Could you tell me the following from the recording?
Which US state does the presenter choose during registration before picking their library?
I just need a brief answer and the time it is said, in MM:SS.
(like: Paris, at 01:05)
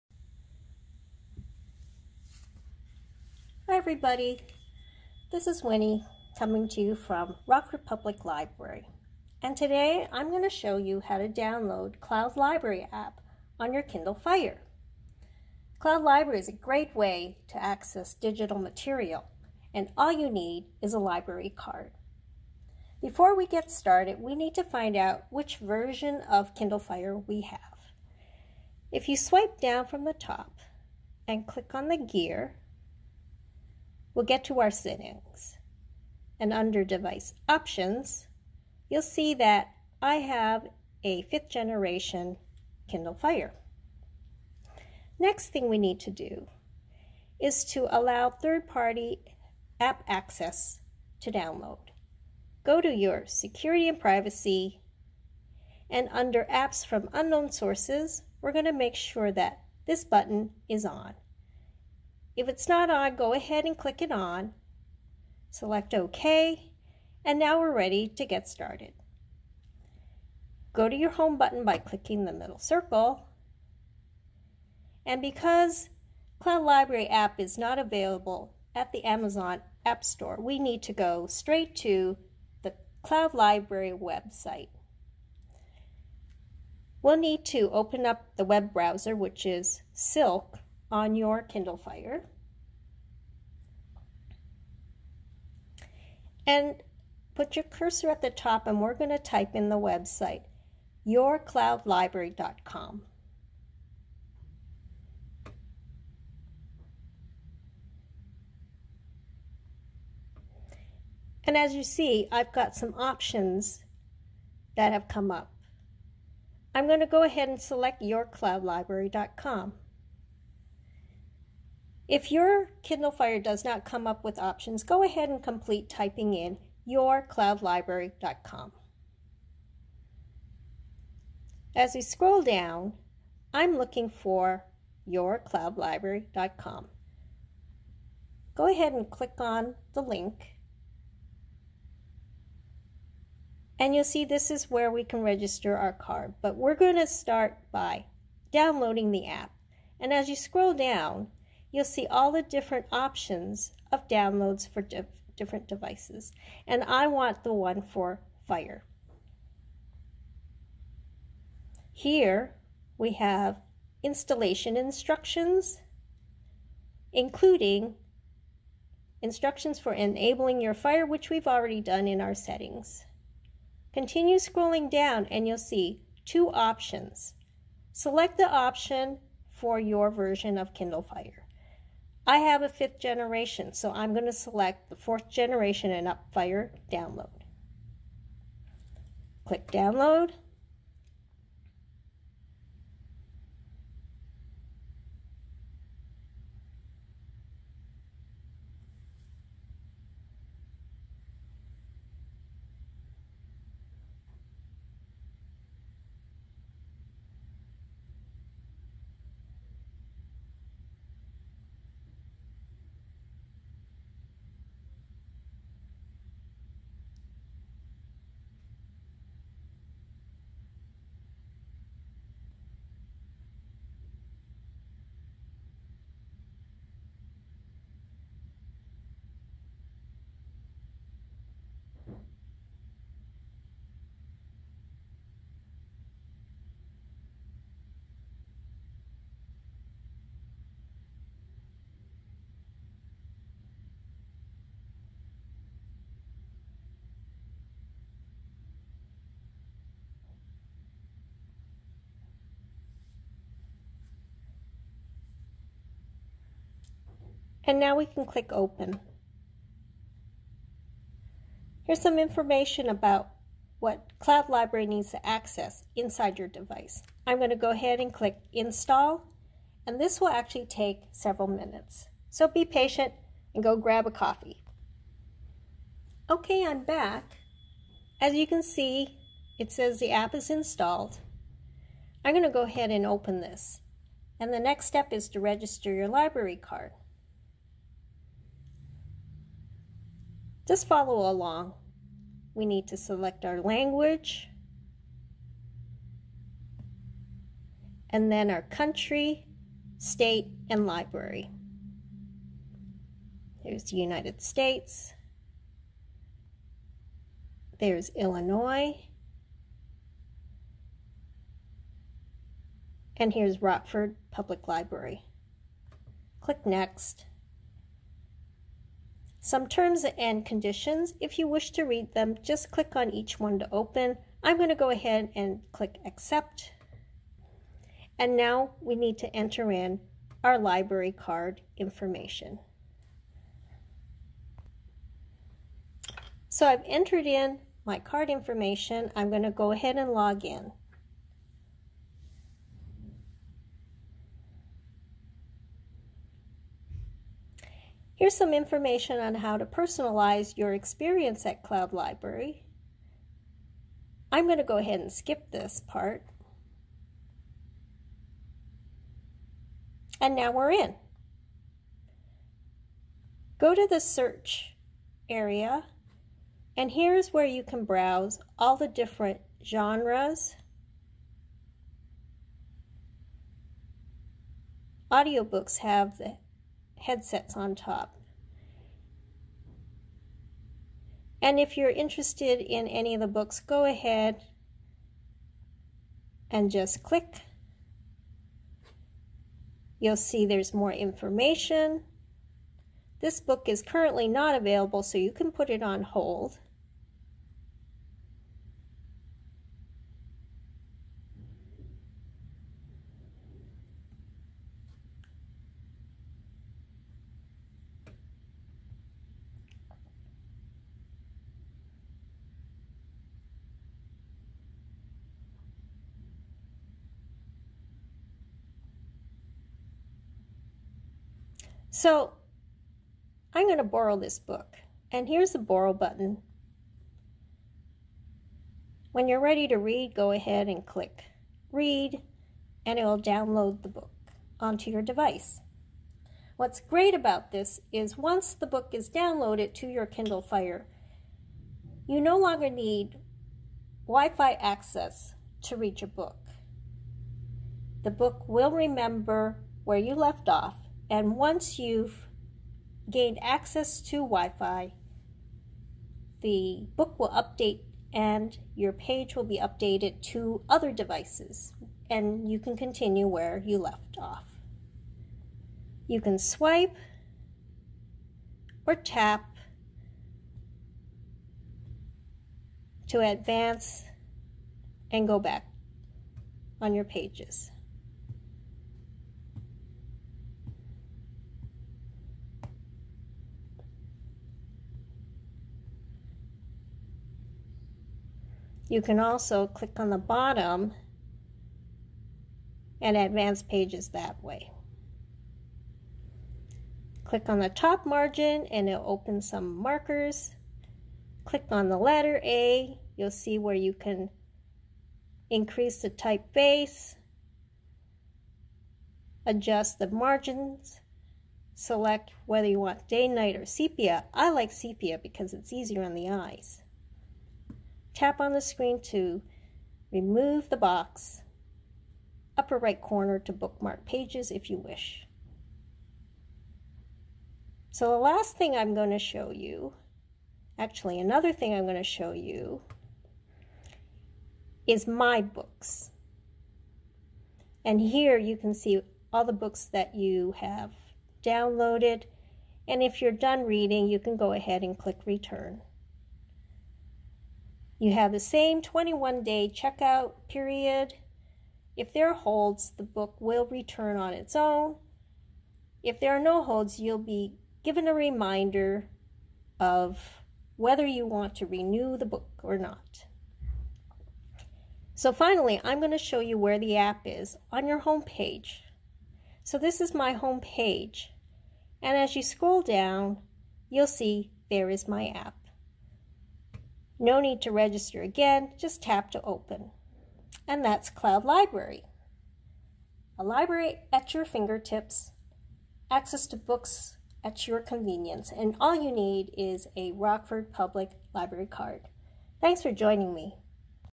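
Illinois, at 05:08.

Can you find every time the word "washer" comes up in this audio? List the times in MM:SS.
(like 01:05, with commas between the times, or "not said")
not said.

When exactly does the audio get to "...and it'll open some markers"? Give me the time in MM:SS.
08:18.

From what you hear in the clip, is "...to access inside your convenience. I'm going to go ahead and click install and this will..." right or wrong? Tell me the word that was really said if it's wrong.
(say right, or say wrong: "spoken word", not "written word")
wrong: "device", not "convenience".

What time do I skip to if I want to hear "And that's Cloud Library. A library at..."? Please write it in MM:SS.
09:40.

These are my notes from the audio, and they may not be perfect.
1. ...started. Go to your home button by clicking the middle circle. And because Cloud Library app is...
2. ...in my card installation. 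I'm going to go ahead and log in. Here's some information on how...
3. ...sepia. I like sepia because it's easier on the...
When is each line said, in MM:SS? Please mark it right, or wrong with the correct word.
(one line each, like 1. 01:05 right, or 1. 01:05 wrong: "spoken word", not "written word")
1. 01:08 right
2. 05:37 wrong: "information", not "installation"
3. 08:33 right.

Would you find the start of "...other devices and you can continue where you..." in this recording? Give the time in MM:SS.
07:40.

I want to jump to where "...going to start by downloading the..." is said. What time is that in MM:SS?
02:26.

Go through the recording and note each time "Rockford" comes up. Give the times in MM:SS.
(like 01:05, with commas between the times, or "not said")
00:07, 05:13, 09:50.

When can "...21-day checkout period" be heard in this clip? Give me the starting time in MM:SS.
09:08.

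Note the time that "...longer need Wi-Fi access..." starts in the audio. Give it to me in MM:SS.
07:22.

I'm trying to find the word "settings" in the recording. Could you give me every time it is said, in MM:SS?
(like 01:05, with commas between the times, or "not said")
00:34, 02:52.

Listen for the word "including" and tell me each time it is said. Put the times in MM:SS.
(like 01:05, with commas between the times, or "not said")
02:47.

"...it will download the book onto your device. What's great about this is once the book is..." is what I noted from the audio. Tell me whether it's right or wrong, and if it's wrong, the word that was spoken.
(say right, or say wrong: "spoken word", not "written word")
right.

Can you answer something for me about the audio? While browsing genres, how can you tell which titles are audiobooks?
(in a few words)
headsets on top.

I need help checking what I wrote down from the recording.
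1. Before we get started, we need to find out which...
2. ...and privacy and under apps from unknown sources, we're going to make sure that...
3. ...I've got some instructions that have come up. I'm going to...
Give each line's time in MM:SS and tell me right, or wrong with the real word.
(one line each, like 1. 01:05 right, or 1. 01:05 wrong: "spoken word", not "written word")
1. 00:23 right
2. 00:53 right
3. 01:52 wrong: "options", not "instructions".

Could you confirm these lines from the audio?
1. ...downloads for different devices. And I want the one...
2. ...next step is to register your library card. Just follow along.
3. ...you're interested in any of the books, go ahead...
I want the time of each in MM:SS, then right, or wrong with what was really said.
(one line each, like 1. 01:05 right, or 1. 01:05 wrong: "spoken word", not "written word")
1. 02:34 right
2. 04:44 right
3. 06:21 right.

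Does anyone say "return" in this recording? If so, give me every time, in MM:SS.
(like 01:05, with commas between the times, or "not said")
09:05, 09:13.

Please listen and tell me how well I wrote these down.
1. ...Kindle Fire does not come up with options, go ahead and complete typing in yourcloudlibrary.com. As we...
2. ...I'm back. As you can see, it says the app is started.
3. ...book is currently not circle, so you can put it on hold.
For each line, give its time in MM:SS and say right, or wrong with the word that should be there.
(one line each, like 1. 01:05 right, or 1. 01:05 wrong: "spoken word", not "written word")
1. 02:02 right
2. 04:36 wrong: "installed", not "started"
3. 06:33 wrong: "available", not "circle".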